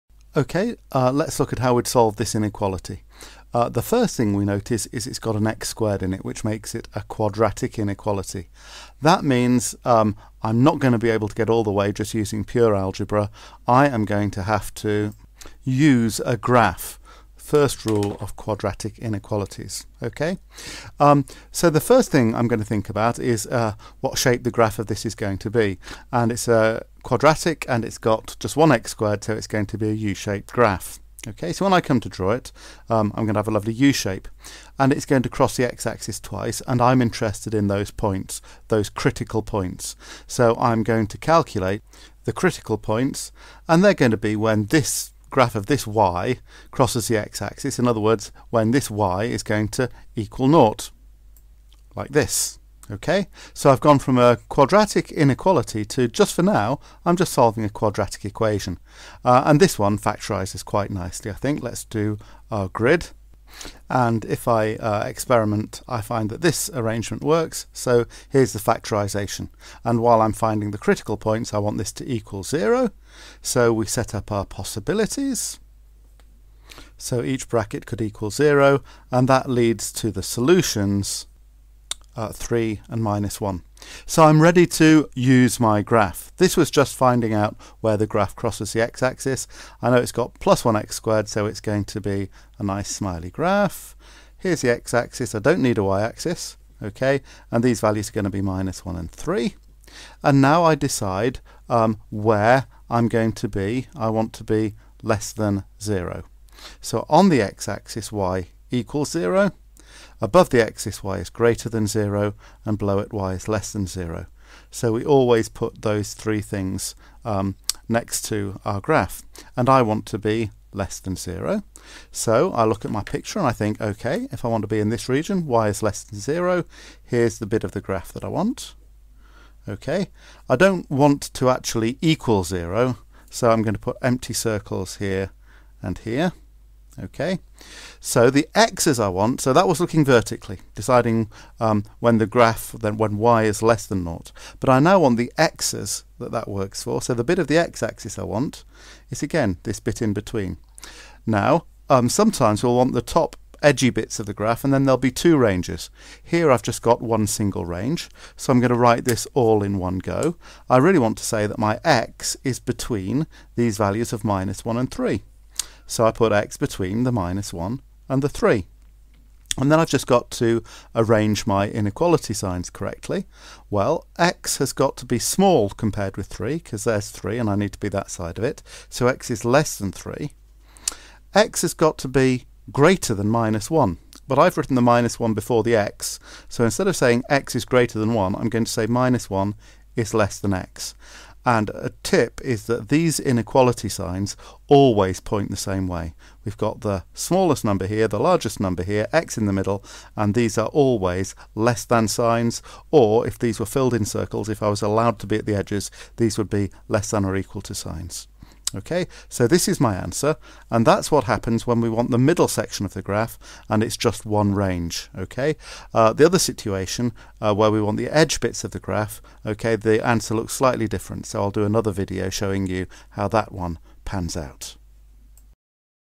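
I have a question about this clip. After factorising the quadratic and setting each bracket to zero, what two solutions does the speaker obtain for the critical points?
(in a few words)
3 and -1.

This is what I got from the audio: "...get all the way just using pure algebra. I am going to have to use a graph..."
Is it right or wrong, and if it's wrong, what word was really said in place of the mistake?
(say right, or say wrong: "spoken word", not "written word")
right.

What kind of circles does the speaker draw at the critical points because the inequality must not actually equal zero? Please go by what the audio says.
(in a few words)
Empty circles.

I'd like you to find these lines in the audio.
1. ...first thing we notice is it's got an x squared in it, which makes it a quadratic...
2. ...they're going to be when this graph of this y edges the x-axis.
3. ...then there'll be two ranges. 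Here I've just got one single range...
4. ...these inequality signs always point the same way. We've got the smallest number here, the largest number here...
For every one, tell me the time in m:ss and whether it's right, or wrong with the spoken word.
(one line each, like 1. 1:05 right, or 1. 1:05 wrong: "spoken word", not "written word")
1. 0:03 right
2. 0:43 wrong: "crosses", not "edges"
3. 2:34 right
4. 3:12 right.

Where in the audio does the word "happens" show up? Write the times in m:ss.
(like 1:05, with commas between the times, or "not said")
3:31.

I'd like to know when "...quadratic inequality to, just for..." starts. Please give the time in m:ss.
0:54.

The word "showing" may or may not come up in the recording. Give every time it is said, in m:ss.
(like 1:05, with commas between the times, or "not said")
3:42.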